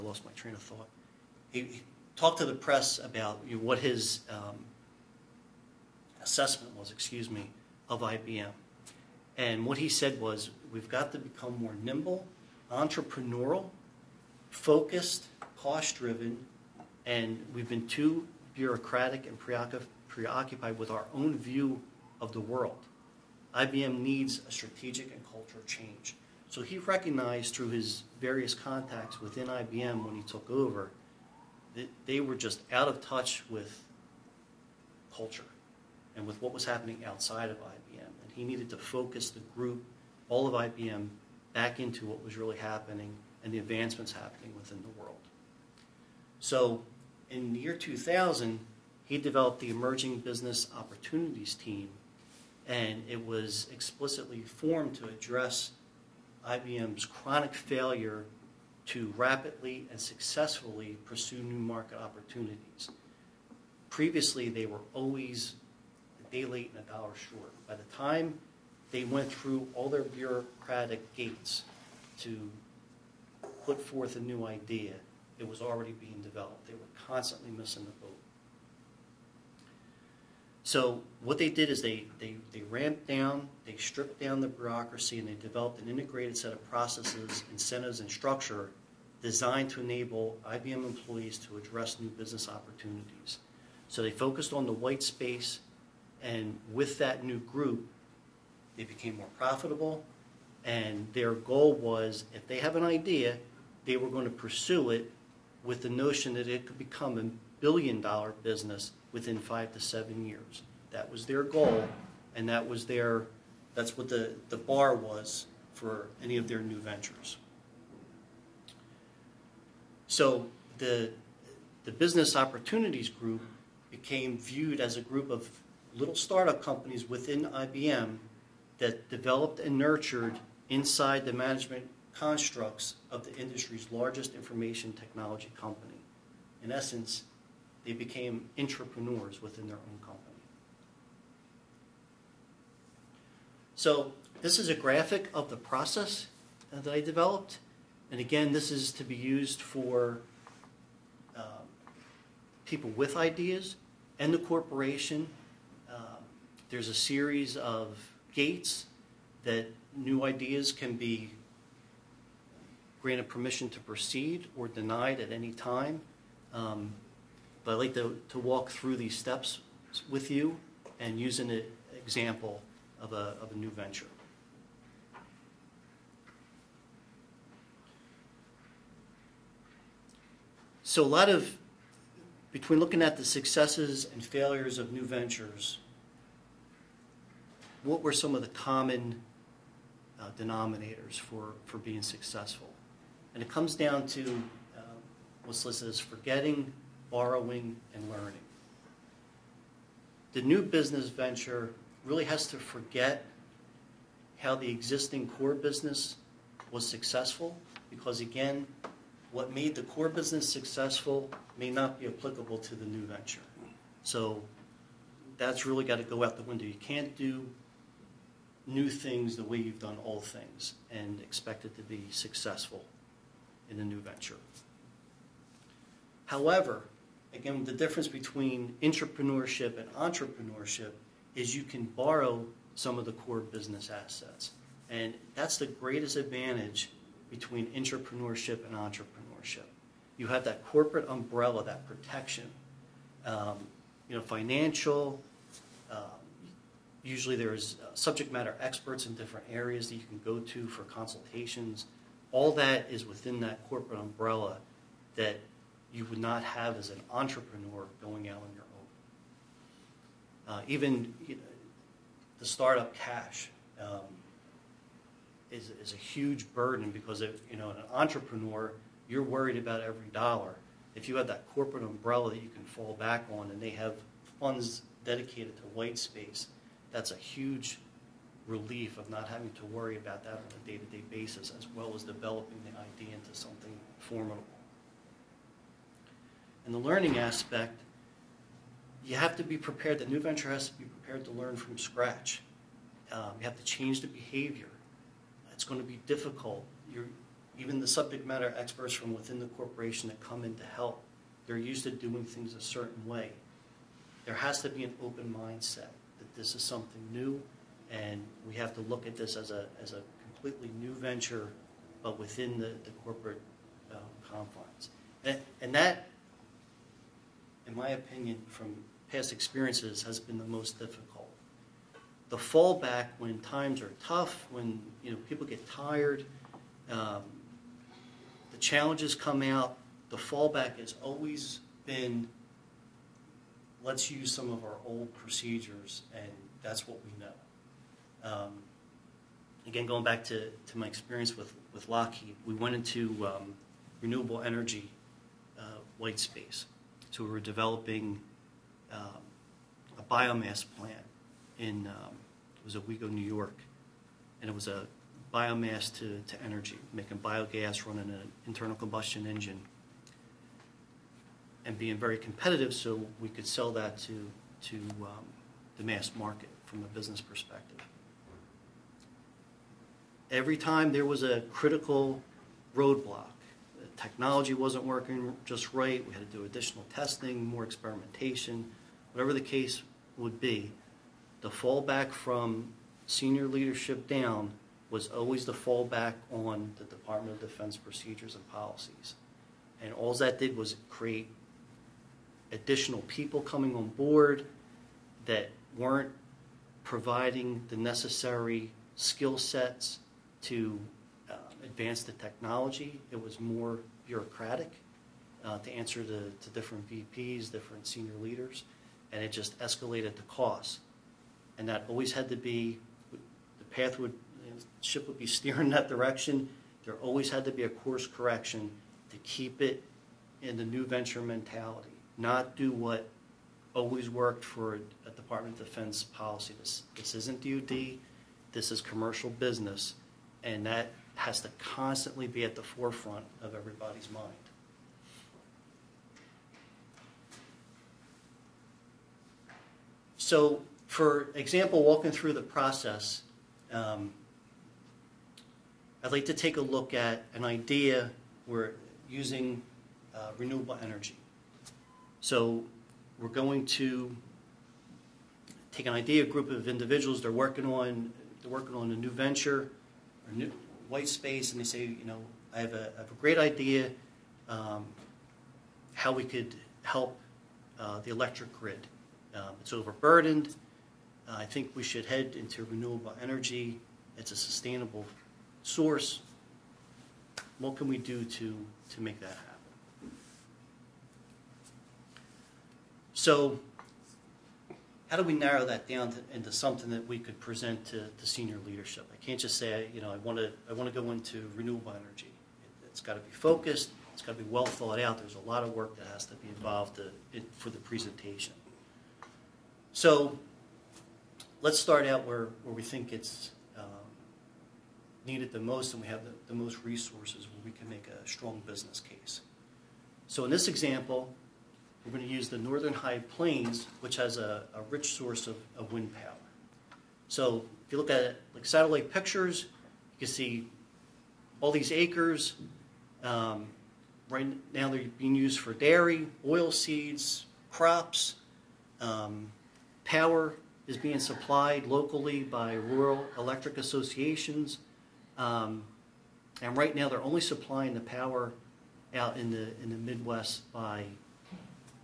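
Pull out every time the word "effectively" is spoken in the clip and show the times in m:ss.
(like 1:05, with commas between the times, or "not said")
not said.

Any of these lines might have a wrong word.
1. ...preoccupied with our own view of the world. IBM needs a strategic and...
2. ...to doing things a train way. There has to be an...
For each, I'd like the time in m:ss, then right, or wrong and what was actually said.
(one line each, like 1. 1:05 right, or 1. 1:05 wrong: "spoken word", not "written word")
1. 0:20 right
2. 5:01 wrong: "certain", not "train".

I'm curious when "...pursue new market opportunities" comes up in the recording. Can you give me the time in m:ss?
1:01.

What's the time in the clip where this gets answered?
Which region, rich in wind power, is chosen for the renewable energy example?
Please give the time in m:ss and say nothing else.
8:32.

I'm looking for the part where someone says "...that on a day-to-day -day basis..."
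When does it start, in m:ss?
4:40.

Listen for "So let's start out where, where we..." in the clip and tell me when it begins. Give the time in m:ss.
8:19.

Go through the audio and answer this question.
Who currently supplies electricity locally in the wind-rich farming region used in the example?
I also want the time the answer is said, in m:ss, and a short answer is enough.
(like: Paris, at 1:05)
rural electric associations, at 8:52.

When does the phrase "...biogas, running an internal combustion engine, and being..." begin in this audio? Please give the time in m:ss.
5:57.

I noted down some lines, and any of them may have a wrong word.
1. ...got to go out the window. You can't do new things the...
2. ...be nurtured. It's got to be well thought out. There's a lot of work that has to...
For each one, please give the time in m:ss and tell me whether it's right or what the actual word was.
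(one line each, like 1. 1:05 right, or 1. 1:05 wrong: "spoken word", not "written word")
1. 3:35 right
2. 8:13 wrong: "focused", not "nurtured".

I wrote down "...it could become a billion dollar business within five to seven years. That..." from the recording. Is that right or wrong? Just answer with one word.
right.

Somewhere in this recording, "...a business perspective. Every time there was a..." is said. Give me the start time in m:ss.
6:06.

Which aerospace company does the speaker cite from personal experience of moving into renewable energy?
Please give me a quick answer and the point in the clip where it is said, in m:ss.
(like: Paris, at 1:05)
Lockheed, at 5:41.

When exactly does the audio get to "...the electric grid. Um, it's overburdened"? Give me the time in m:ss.
7:48.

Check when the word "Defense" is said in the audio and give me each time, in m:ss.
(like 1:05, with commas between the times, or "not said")
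6:27, 7:05.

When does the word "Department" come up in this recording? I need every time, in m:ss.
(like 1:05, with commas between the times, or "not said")
6:26, 7:05.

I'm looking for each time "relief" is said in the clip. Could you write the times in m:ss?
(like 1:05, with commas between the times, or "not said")
4:38.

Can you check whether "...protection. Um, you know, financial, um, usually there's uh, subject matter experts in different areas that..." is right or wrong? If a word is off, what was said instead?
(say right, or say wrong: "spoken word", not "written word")
right.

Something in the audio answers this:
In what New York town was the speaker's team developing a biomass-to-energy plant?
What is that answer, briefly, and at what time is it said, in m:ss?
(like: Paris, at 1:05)
Owego, at 5:52.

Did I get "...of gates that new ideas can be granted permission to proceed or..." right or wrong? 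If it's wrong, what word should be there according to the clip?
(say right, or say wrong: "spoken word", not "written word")
right.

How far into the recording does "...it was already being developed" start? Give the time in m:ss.
1:15.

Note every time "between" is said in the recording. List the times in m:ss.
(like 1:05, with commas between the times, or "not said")
3:02, 3:48, 3:57.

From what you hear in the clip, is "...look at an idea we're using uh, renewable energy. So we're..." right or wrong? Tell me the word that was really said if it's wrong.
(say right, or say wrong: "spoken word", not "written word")
right.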